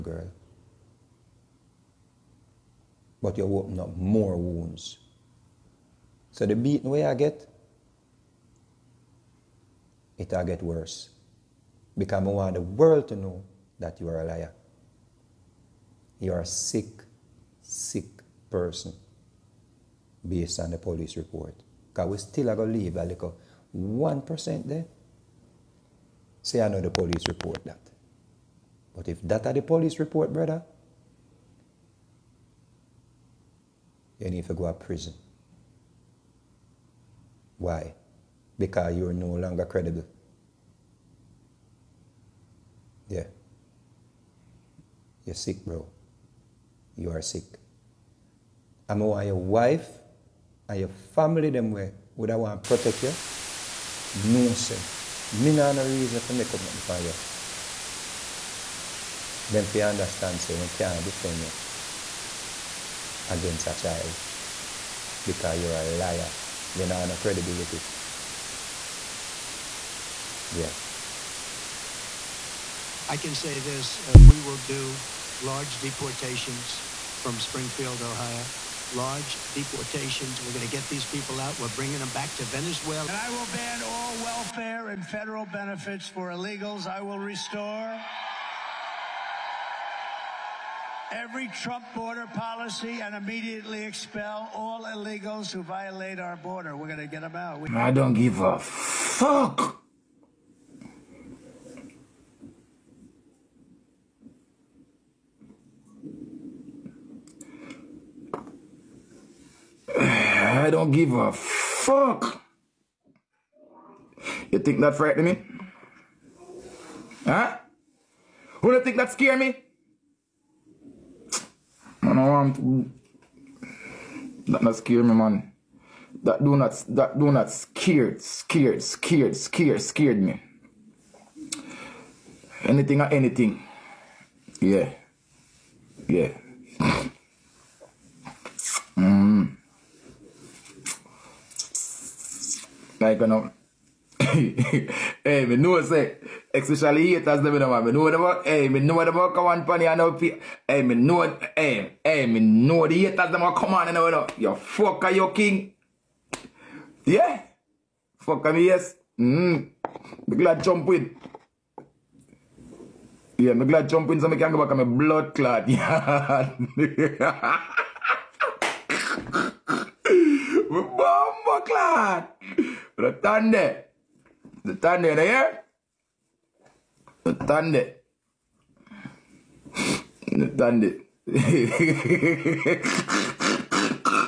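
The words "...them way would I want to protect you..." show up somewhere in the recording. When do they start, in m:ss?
0:51.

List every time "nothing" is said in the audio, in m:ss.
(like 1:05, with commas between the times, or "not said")
0:56.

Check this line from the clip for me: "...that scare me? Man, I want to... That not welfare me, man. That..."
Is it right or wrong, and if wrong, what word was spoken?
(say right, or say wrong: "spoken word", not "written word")
wrong: "scare", not "welfare".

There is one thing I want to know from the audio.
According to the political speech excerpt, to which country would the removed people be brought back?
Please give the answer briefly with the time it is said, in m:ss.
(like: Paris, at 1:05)
Venezuela, at 1:22.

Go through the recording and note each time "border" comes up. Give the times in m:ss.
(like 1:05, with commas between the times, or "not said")
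1:31, 1:36.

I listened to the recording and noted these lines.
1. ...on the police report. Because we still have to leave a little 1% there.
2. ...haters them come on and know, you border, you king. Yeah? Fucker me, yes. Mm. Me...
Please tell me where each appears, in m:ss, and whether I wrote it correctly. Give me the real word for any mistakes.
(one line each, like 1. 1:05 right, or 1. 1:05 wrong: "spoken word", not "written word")
1. 0:20 right
2. 2:33 wrong: "fucker", not "border".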